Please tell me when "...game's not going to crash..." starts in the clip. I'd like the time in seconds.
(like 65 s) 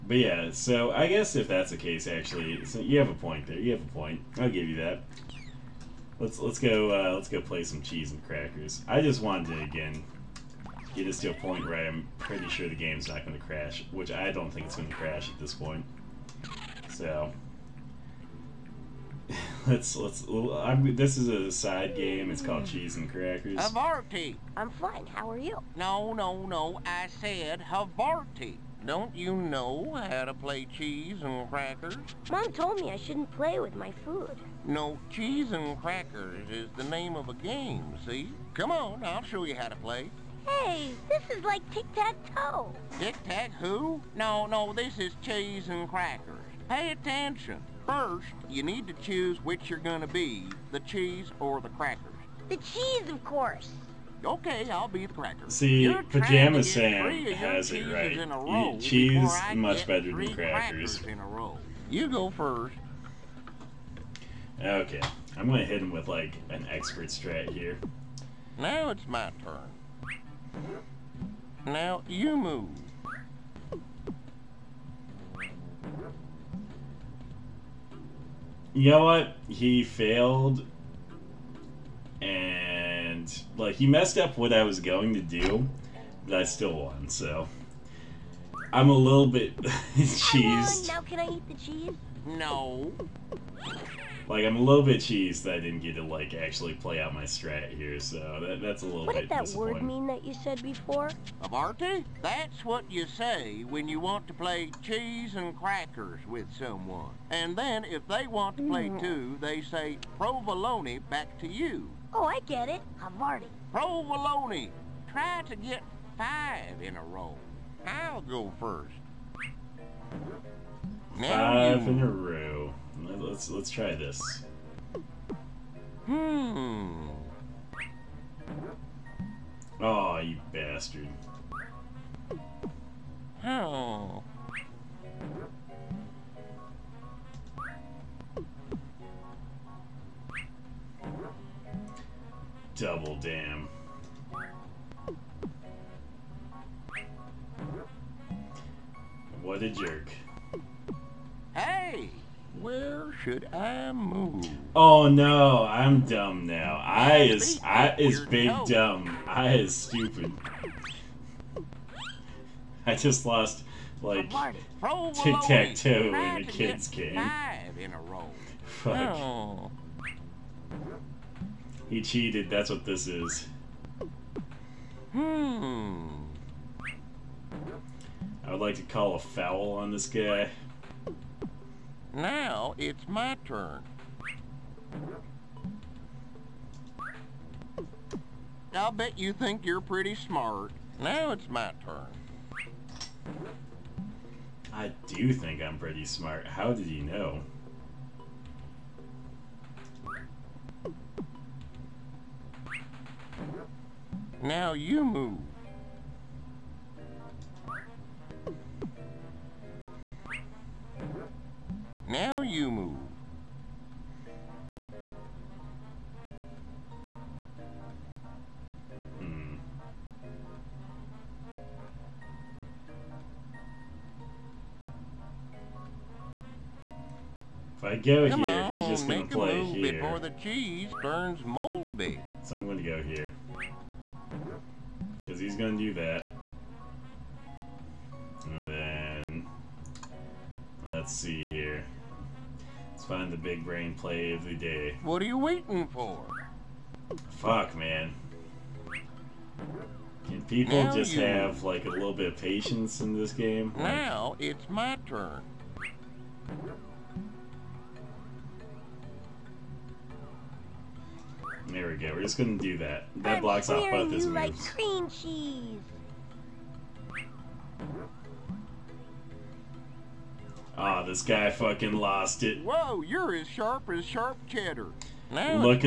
12 s.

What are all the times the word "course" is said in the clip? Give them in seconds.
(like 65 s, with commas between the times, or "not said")
53 s.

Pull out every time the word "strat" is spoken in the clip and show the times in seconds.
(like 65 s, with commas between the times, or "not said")
67 s, 97 s.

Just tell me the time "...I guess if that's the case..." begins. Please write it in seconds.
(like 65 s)
0 s.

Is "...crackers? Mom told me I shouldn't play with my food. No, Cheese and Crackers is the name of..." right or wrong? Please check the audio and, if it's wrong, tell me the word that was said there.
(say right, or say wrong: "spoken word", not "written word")
right.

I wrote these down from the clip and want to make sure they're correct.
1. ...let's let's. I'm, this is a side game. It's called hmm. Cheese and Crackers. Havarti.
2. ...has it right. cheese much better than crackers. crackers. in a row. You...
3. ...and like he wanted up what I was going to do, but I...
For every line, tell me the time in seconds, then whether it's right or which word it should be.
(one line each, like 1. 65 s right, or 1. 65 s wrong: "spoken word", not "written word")
1. 19 s right
2. 57 s right
3. 82 s wrong: "messed", not "wanted".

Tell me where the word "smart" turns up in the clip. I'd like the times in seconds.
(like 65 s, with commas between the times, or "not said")
190 s, 196 s.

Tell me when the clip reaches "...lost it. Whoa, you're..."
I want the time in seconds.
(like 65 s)
271 s.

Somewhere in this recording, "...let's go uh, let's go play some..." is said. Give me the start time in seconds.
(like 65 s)
6 s.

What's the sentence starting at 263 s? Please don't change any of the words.
That blocks off both his moves.